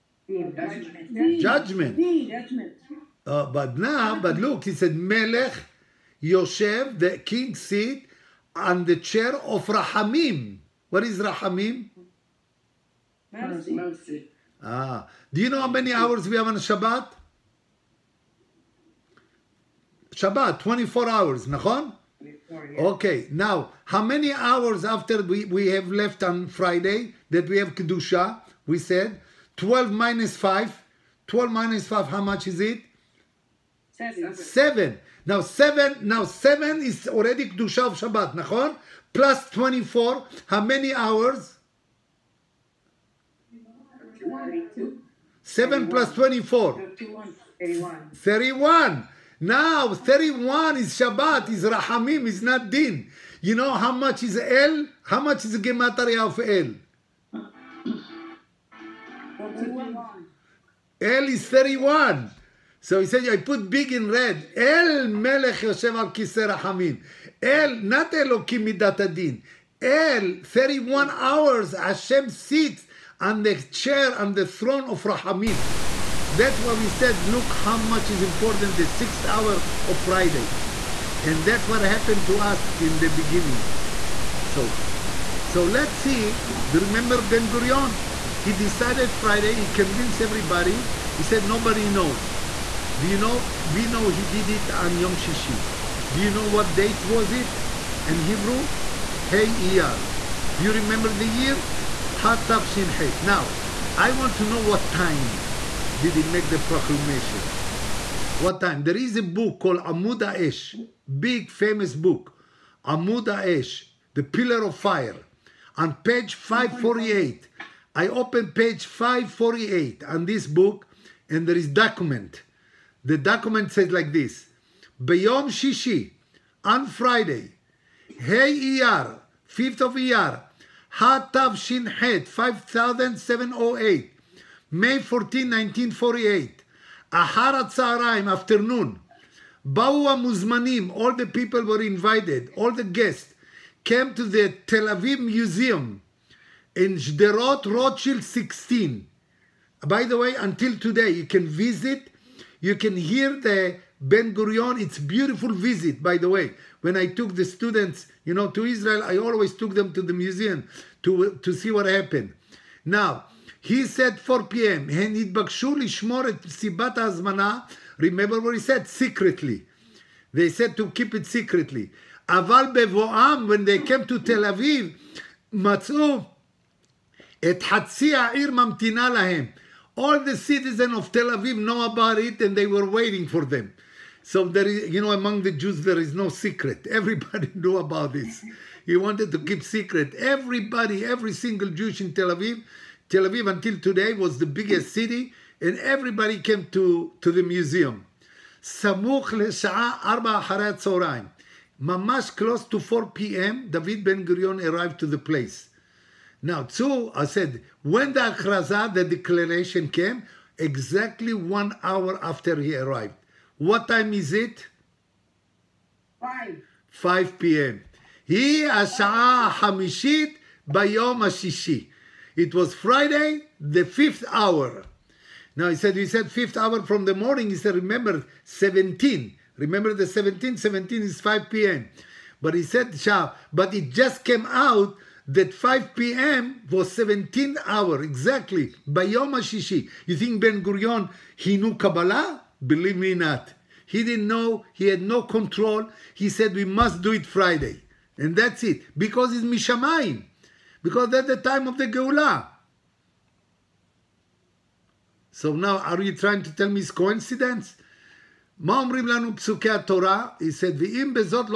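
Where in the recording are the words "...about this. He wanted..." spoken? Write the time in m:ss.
3:07.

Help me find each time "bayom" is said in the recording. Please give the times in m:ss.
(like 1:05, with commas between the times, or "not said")
3:40, 3:58.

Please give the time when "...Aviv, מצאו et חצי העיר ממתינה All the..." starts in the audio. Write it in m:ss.
2:54.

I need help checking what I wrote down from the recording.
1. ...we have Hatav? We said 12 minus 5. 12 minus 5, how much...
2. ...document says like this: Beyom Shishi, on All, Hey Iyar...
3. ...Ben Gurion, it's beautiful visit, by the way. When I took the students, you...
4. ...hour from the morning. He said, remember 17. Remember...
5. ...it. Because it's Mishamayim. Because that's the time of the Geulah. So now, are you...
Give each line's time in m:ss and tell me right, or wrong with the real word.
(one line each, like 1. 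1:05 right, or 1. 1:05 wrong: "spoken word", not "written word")
1. 0:27 wrong: "Kedusha", not "Hatav"
2. 2:03 wrong: "Friday", not "All"
3. 2:34 right
4. 3:46 right
5. 4:08 right.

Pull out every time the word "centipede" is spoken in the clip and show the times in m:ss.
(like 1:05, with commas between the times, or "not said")
not said.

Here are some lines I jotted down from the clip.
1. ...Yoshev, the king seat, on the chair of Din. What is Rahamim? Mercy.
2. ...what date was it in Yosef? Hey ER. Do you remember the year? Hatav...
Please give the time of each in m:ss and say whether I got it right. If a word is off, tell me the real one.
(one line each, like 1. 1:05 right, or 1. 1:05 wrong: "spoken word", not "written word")
1. 0:06 wrong: "Rahamim", not "Din"
2. 1:36 wrong: "Hebrew", not "Yosef".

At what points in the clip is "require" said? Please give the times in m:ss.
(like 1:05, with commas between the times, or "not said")
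not said.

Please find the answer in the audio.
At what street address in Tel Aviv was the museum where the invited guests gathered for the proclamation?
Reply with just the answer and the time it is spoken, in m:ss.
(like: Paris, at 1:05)
Rothschild 16, at 2:26.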